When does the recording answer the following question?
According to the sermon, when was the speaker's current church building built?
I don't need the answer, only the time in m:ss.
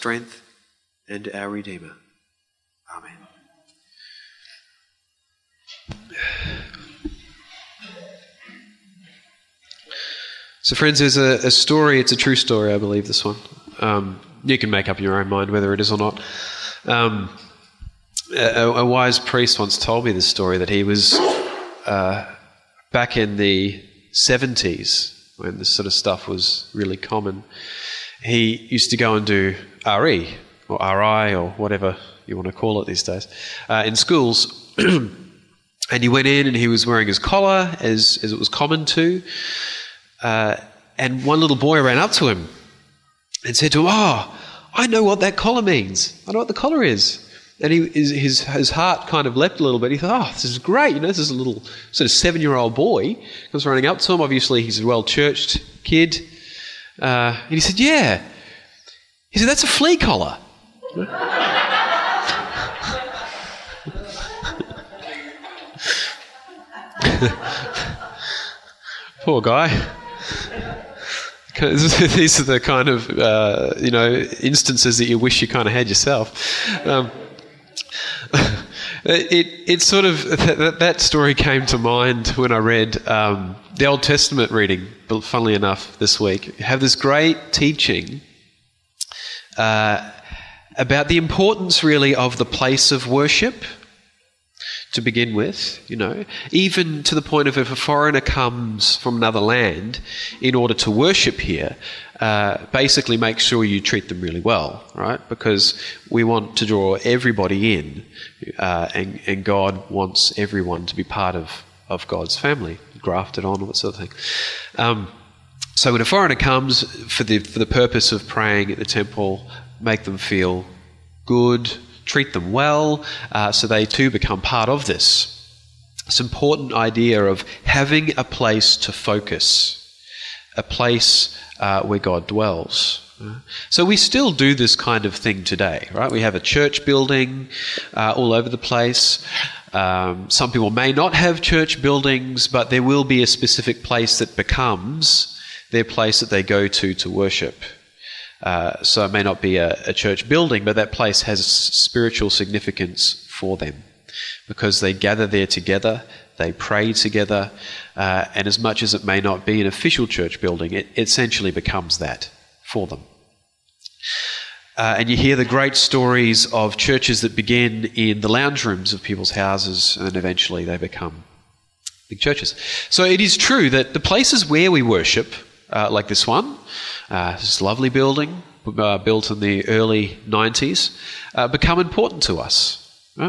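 2:59.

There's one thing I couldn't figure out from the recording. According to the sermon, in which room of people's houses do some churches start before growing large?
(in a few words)
Lounge rooms.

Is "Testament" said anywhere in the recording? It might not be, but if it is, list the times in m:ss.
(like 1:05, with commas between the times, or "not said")
1:24.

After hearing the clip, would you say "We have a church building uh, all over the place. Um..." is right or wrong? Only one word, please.
right.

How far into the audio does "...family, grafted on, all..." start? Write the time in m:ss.
1:52.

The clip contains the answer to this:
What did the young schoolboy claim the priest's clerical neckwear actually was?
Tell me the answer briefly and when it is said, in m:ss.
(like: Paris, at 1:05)
A flea collar, at 0:59.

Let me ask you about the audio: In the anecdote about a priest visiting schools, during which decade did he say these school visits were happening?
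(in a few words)
1970s.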